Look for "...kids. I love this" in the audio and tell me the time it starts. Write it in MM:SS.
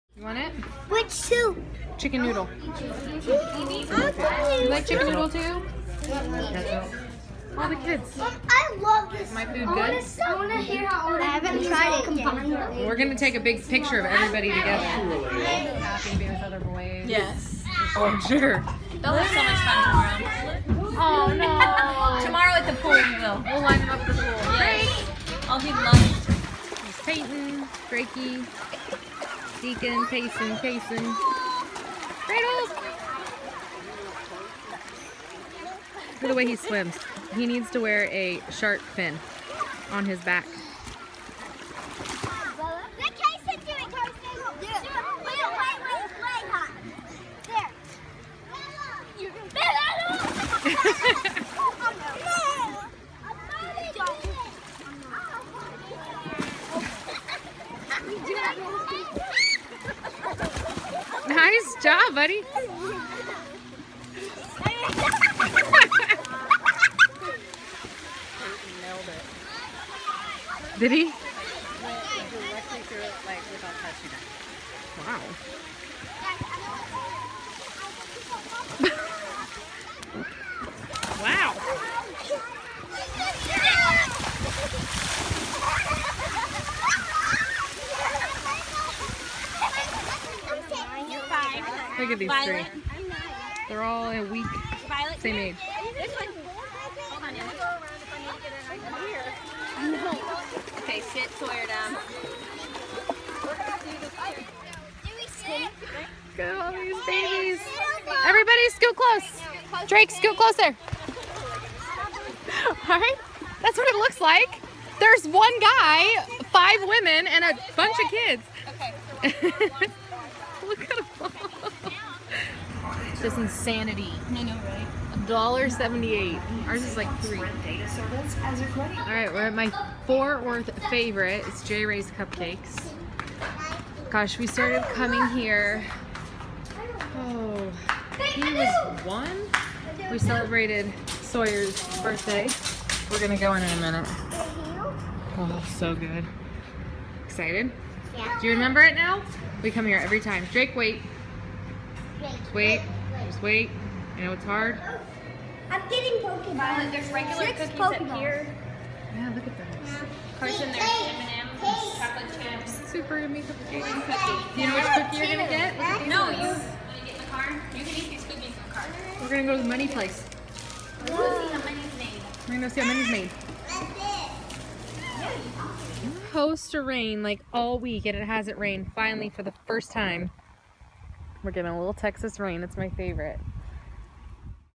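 00:07.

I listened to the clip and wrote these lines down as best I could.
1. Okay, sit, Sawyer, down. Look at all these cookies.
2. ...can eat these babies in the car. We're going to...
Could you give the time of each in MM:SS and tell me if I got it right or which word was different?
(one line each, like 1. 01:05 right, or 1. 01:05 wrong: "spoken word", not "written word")
1. 01:40 wrong: "babies", not "cookies"
2. 02:47 wrong: "cookies", not "babies".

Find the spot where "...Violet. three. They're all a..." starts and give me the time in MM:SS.
01:32.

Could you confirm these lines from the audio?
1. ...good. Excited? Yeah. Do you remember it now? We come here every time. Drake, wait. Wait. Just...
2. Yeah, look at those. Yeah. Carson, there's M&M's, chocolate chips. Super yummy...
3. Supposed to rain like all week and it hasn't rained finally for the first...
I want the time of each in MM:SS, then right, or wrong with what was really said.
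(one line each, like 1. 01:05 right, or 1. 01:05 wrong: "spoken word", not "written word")
1. 02:25 right
2. 02:39 right
3. 02:56 right.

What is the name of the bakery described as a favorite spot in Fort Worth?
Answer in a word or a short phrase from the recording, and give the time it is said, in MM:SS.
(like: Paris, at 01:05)
J. Ray's Cupcakes, at 02:11.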